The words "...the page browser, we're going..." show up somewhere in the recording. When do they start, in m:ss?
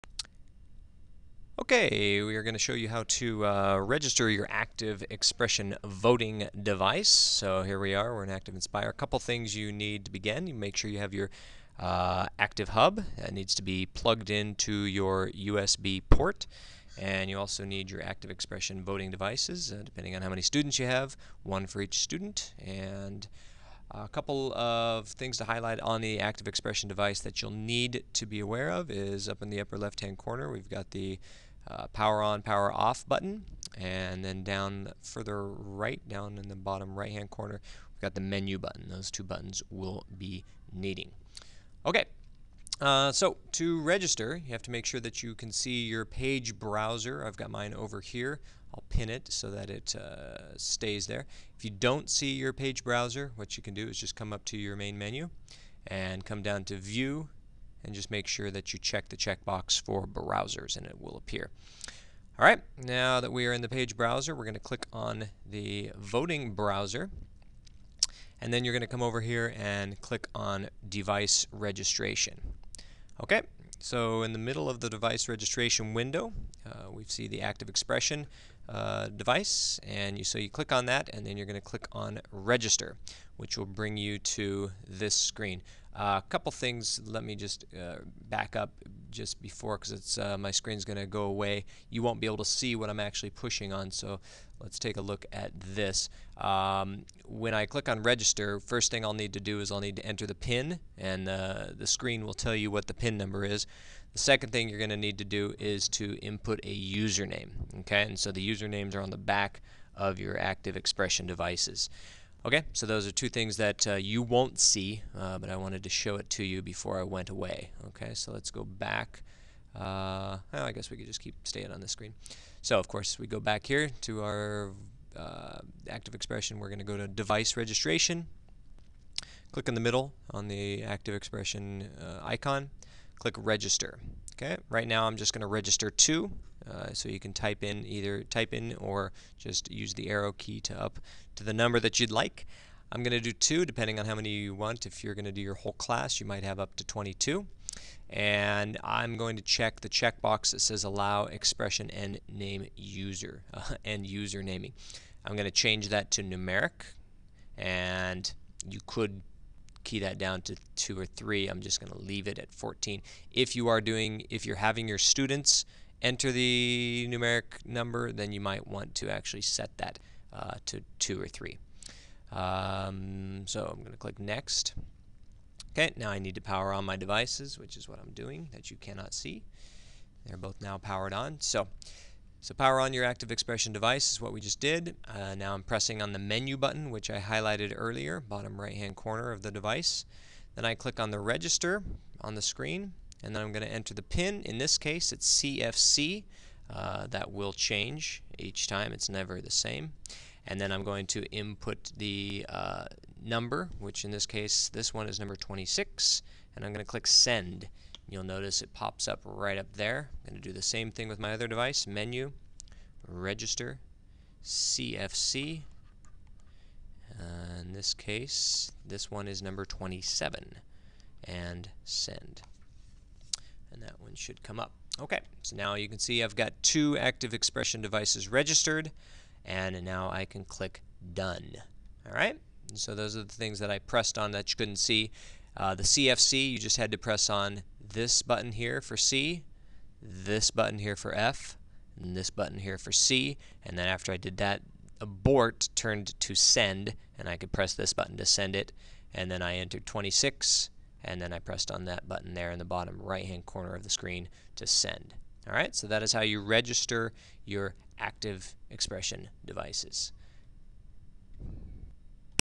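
1:03.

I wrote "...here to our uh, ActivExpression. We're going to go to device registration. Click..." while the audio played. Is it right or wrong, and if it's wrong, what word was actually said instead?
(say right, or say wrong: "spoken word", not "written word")
right.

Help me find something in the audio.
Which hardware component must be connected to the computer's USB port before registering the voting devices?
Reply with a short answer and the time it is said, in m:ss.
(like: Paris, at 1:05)
ActivHub, at 0:12.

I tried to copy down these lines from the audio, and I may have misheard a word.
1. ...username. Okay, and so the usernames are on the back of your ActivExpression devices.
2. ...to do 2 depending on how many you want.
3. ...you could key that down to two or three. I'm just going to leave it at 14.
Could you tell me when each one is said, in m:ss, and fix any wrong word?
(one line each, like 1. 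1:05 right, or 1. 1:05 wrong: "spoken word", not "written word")
1. 1:46 right
2. 2:23 right
3. 2:38 right.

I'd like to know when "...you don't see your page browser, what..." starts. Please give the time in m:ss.
0:51.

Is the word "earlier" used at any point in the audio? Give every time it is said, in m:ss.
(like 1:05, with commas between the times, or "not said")
3:07.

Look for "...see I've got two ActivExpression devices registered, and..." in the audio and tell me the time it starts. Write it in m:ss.
3:45.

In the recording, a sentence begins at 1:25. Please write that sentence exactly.
A uh, couple things, let me just uh, back up just before because it's uh, my screen's going to go away.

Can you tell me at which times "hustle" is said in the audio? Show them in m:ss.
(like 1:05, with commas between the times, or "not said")
not said.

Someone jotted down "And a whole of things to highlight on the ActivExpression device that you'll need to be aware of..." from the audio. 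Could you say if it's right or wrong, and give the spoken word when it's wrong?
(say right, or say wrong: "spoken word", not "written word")
wrong: "couple", not "whole".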